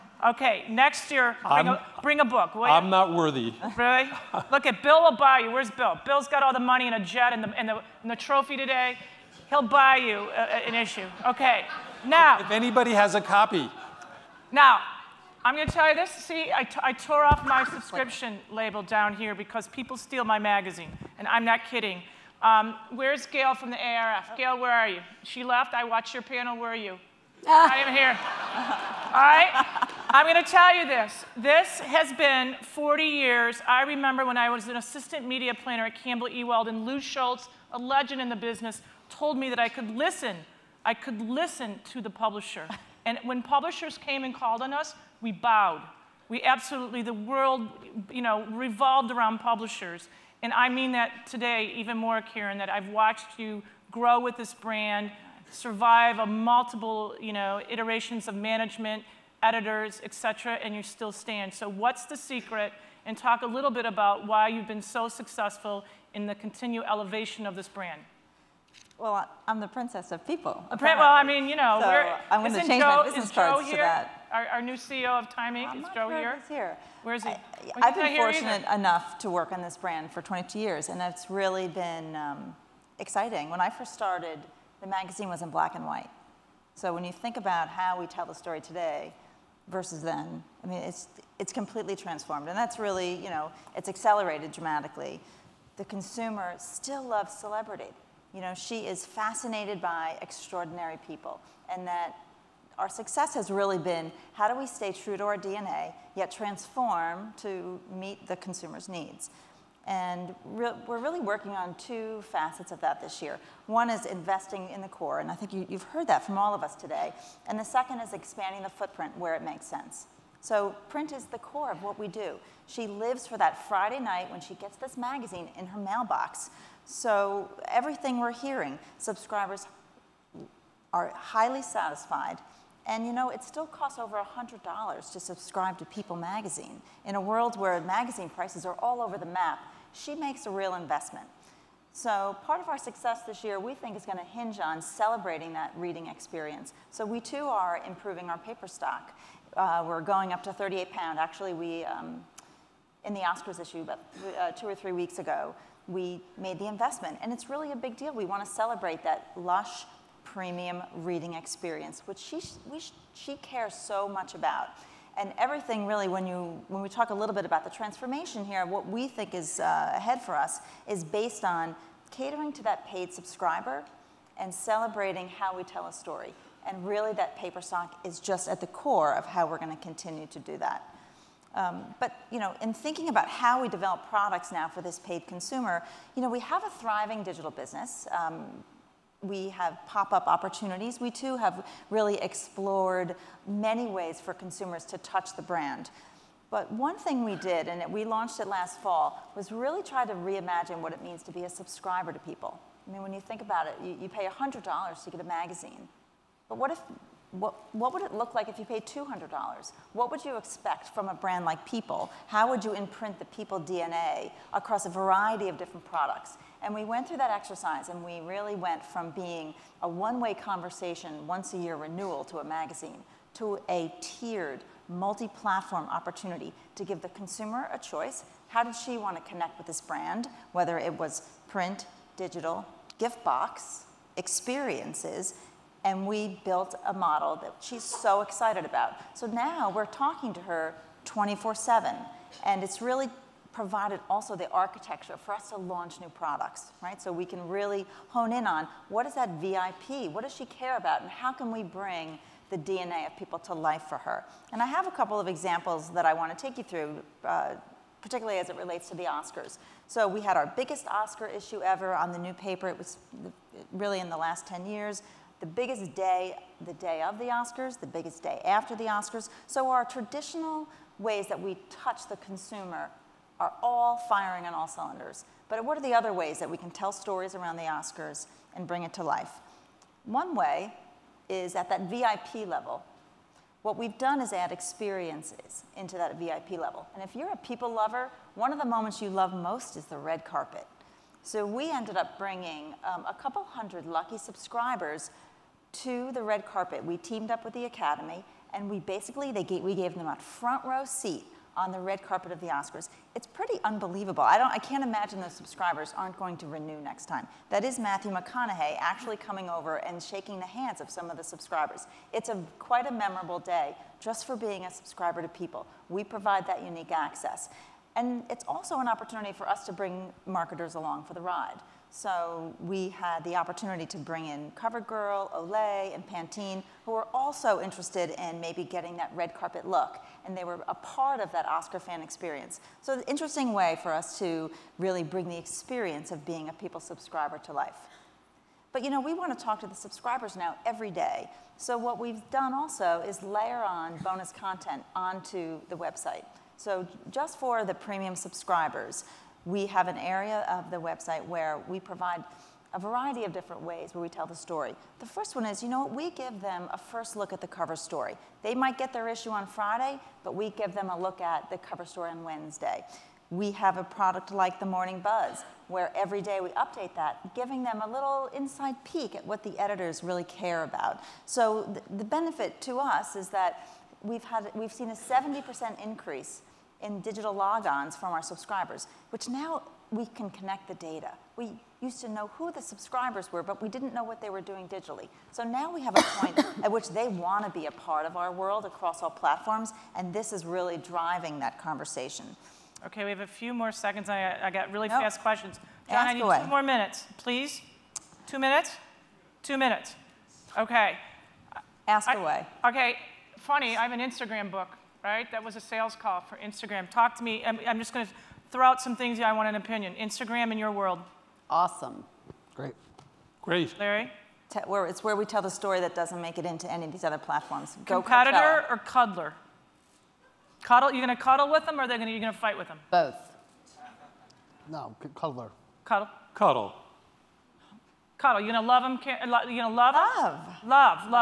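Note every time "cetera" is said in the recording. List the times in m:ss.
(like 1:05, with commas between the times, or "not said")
1:00.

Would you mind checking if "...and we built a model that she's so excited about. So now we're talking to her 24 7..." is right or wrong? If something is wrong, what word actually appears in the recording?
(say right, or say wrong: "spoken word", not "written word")
right.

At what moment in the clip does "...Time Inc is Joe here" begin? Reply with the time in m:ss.
1:15.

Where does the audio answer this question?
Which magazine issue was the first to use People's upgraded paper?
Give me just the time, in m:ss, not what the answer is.
2:33.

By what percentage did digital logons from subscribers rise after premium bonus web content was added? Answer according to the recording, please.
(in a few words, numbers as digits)
70%.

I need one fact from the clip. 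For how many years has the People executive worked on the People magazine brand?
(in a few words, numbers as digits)
22 years.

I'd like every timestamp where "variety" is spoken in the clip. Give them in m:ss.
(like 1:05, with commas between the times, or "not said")
3:34, 5:52.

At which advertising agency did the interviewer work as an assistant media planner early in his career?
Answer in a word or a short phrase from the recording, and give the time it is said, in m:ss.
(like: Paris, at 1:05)
Campbell Ewald, at 0:36.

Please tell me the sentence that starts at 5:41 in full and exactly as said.
So what we've done also is layer on bonus content onto the website.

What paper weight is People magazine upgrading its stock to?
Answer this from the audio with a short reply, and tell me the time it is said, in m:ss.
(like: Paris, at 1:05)
38 pound, at 2:30.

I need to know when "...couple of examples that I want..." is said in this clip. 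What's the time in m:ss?
4:14.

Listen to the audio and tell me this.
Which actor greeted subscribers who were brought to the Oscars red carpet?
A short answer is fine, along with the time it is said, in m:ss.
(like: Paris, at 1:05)
Matthew McConaughey, at 5:07.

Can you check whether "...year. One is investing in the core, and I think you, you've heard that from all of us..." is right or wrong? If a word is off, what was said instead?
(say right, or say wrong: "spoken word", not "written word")
right.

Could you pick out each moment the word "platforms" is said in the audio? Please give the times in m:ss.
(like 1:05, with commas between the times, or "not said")
3:44, 6:29, 6:57.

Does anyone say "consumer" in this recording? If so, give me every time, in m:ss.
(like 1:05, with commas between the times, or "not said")
1:35, 1:48, 3:05, 3:14, 3:47, 4:32.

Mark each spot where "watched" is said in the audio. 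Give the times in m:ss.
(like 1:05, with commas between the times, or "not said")
0:25, 0:52.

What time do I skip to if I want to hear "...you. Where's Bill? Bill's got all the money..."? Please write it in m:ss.
0:05.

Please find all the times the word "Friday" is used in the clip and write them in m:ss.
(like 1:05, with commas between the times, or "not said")
2:03, 5:59.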